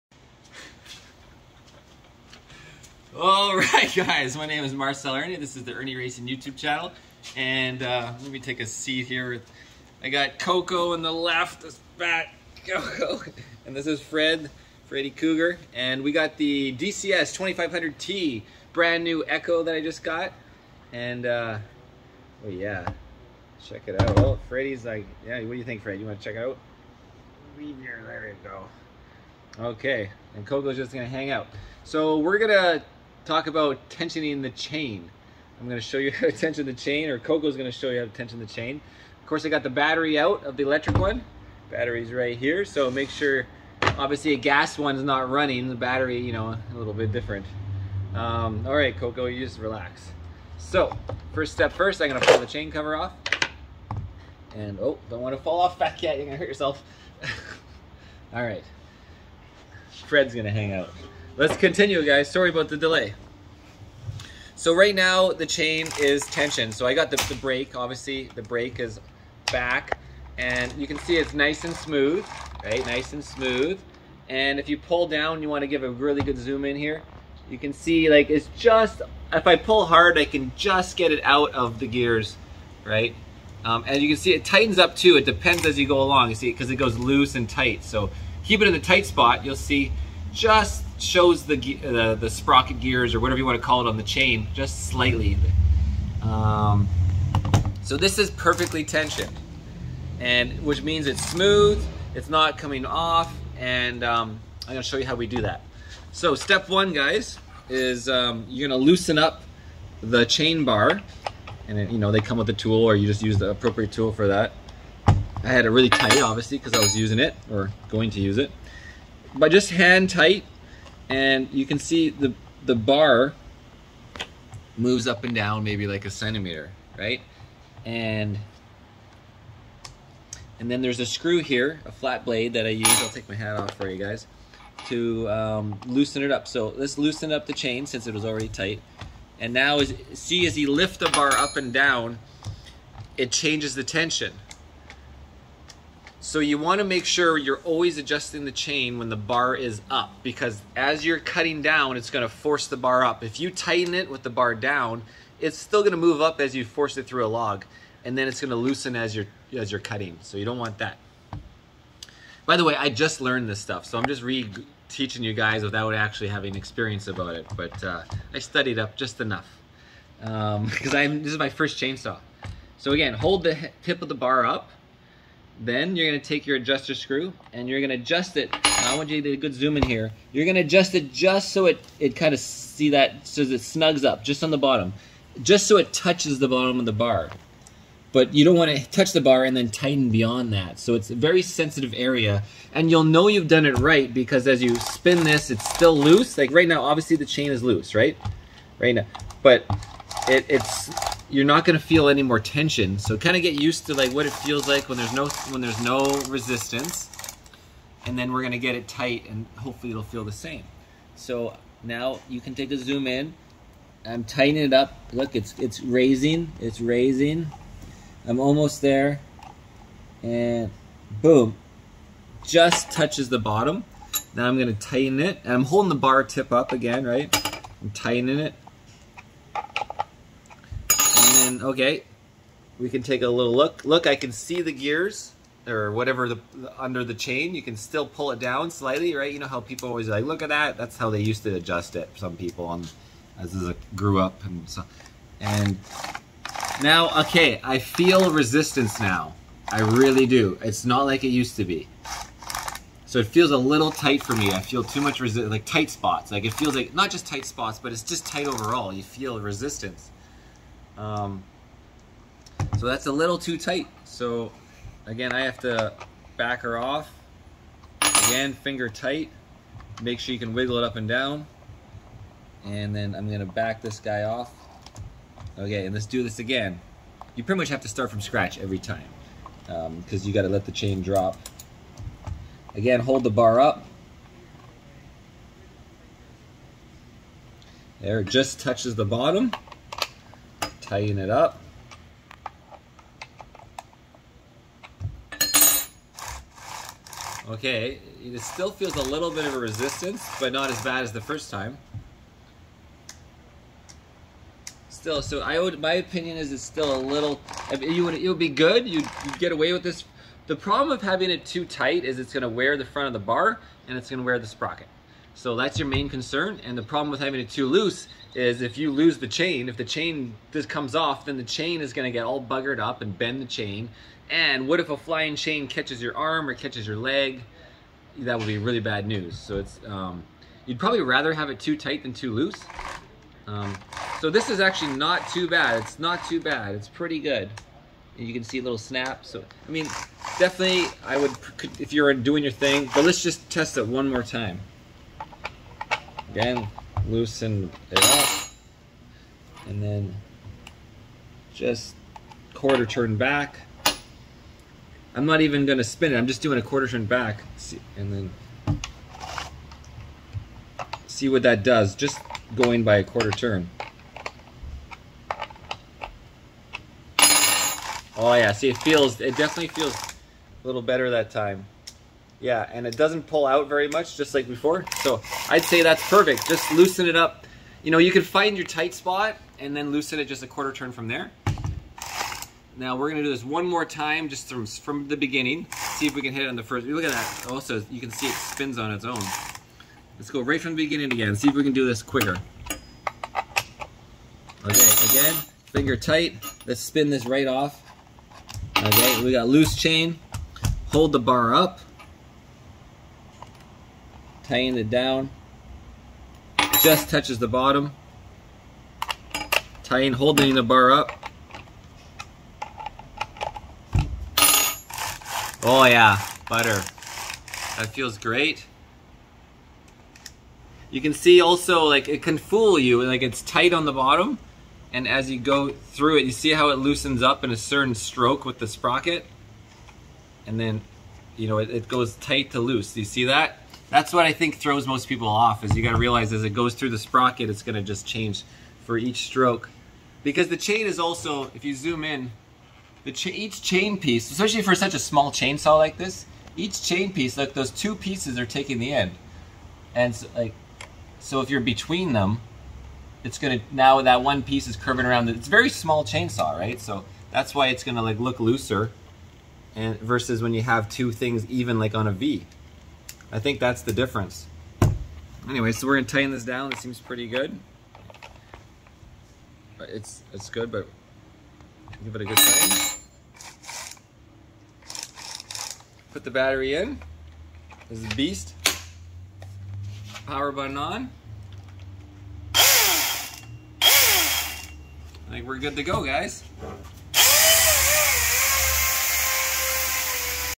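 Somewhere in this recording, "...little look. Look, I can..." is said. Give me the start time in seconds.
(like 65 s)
233 s.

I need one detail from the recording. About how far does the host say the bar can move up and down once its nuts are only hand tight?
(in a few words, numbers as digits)
a centimeter.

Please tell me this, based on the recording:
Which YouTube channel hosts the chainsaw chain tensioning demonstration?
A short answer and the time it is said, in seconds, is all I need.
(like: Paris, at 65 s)
Irnie Racing, at 5 s.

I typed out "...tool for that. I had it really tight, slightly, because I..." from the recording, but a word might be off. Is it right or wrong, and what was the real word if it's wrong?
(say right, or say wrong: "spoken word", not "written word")
wrong: "obviously", not "slightly".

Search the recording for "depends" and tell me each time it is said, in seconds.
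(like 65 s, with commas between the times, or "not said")
85 s.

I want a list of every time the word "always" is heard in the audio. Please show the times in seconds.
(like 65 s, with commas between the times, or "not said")
147 s, 239 s.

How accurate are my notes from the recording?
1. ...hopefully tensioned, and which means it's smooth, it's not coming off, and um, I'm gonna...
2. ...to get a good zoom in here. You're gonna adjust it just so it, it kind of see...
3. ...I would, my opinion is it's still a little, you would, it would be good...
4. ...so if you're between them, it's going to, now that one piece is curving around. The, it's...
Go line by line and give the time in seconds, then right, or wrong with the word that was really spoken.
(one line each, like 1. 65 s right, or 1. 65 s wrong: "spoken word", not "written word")
1. 98 s wrong: "perfectly", not "hopefully"
2. 179 s right
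3. 305 s right
4. 451 s right.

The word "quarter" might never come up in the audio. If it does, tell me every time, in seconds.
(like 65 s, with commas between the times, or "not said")
352 s, 356 s, 363 s, 380 s.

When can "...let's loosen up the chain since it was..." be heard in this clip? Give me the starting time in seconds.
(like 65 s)
136 s.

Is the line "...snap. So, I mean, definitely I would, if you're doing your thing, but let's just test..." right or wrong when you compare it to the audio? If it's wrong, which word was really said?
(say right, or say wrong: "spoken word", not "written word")
right.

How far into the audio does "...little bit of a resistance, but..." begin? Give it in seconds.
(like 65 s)
299 s.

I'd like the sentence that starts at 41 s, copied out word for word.
Battery's right here, so make sure, obviously a gas one's not running, the battery, you know, a little bit different.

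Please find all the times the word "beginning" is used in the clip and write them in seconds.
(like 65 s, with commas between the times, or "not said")
385 s, 390 s.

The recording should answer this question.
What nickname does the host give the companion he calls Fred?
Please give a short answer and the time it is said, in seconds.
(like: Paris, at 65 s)
Freddy Cougar, at 14 s.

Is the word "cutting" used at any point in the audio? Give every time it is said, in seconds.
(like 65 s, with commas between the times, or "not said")
151 s, 159 s.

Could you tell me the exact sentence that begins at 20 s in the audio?
And, uh, oh yeah, check it out.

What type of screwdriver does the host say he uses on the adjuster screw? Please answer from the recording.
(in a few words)
flat blade.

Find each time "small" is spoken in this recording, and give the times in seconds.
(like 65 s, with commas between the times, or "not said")
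444 s, 455 s.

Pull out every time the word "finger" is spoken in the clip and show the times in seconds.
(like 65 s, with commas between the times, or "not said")
268 s, 395 s.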